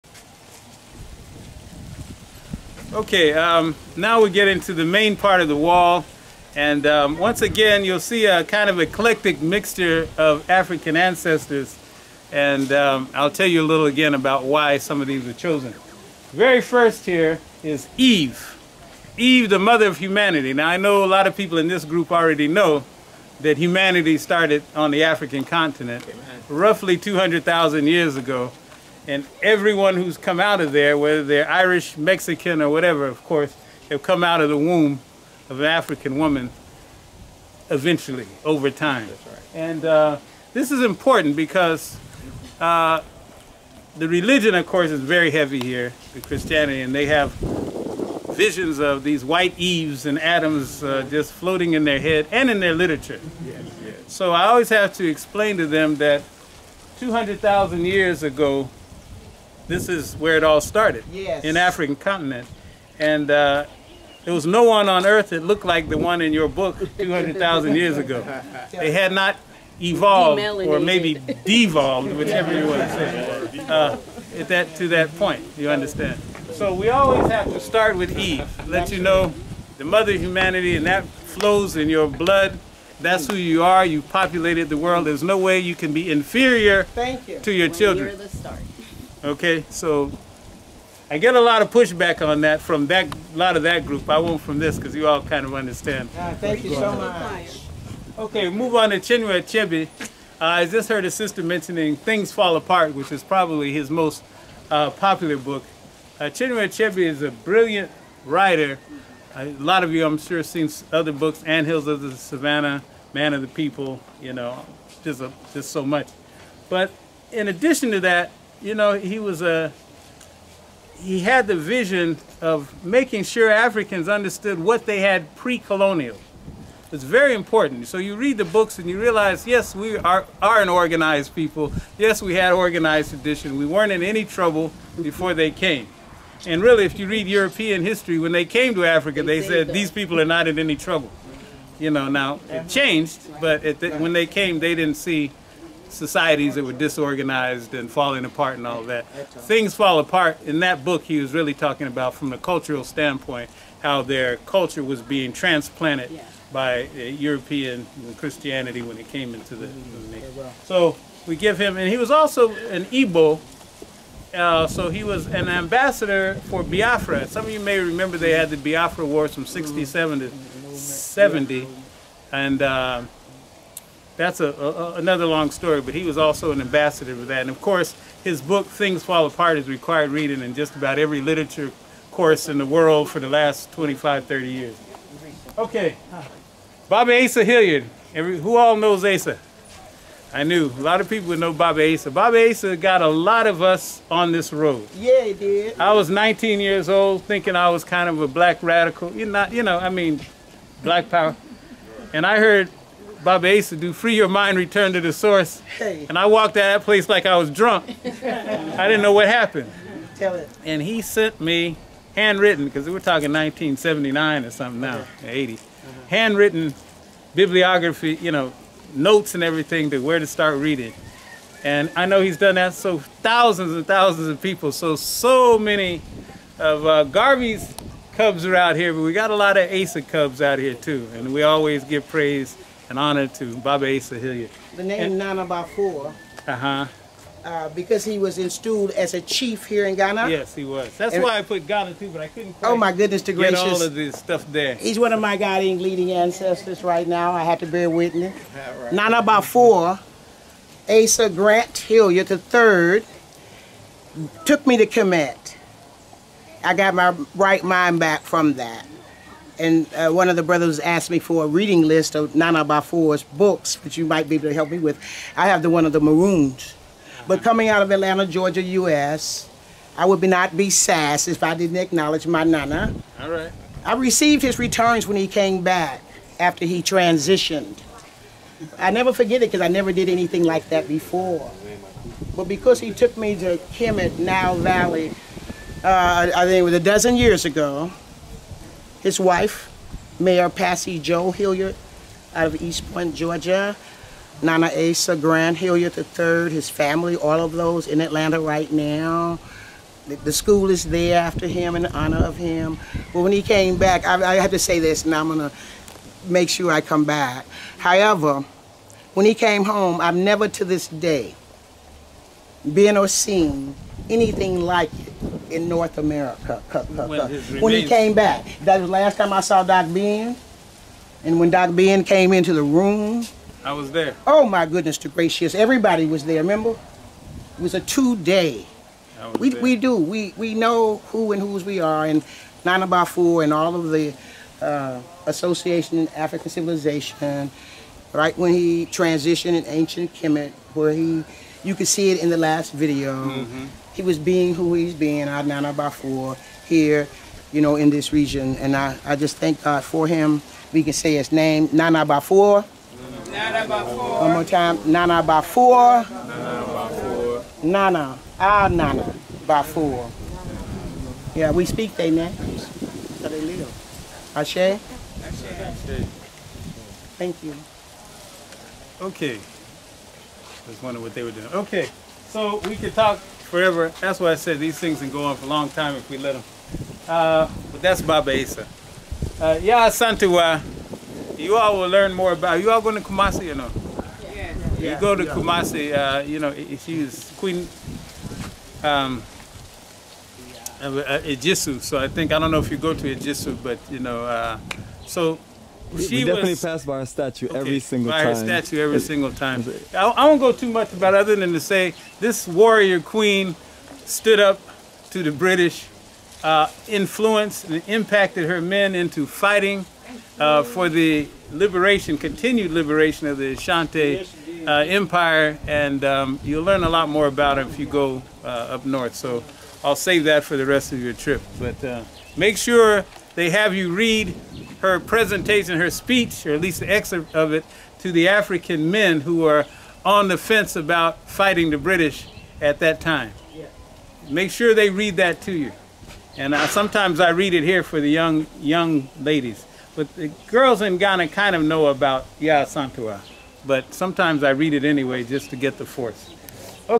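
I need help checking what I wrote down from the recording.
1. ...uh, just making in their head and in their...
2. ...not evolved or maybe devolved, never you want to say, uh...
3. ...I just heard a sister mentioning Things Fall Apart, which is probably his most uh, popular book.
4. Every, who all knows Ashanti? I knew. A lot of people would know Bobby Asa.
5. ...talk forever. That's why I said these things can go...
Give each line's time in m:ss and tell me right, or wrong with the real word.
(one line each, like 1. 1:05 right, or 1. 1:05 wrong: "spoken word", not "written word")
1. 0:50 wrong: "floating", not "making"
2. 1:09 wrong: "whichever", not "never"
3. 1:40 right
4. 3:08 wrong: "Asa", not "Ashanti"
5. 6:12 right.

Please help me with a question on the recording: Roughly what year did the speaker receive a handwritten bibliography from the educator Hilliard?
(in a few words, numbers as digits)
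1979.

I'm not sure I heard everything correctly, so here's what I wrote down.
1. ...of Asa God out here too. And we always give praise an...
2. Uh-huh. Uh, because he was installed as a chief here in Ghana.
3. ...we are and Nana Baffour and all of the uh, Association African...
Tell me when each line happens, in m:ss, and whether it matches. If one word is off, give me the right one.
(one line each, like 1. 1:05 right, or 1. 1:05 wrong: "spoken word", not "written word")
1. 3:49 wrong: "Cubs", not "God"
2. 3:56 right
3. 5:31 right.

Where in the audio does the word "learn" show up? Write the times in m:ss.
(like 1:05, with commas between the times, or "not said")
6:21, 6:56.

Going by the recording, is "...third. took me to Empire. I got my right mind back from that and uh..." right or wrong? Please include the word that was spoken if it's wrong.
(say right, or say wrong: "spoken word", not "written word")
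wrong: "Kemet", not "Empire".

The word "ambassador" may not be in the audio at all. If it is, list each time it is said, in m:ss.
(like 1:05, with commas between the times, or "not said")
2:45, 2:56.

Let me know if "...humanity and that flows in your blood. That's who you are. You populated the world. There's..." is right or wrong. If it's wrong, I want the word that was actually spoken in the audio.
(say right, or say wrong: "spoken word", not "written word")
right.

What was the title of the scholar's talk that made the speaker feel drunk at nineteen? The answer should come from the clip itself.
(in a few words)
Free Your Mind, Return to the Source.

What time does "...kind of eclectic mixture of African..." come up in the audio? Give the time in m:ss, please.
0:08.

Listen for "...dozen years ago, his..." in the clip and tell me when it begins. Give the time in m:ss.
4:46.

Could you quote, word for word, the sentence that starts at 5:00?
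The, the school is there after him in honor of him.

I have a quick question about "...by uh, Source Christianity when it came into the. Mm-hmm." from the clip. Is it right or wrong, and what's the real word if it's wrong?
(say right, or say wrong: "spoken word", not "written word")
wrong: "European", not "Source".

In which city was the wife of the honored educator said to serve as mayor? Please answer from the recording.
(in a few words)
East Point, Georgia.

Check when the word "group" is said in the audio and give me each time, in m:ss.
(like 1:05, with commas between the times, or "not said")
0:21, 1:33.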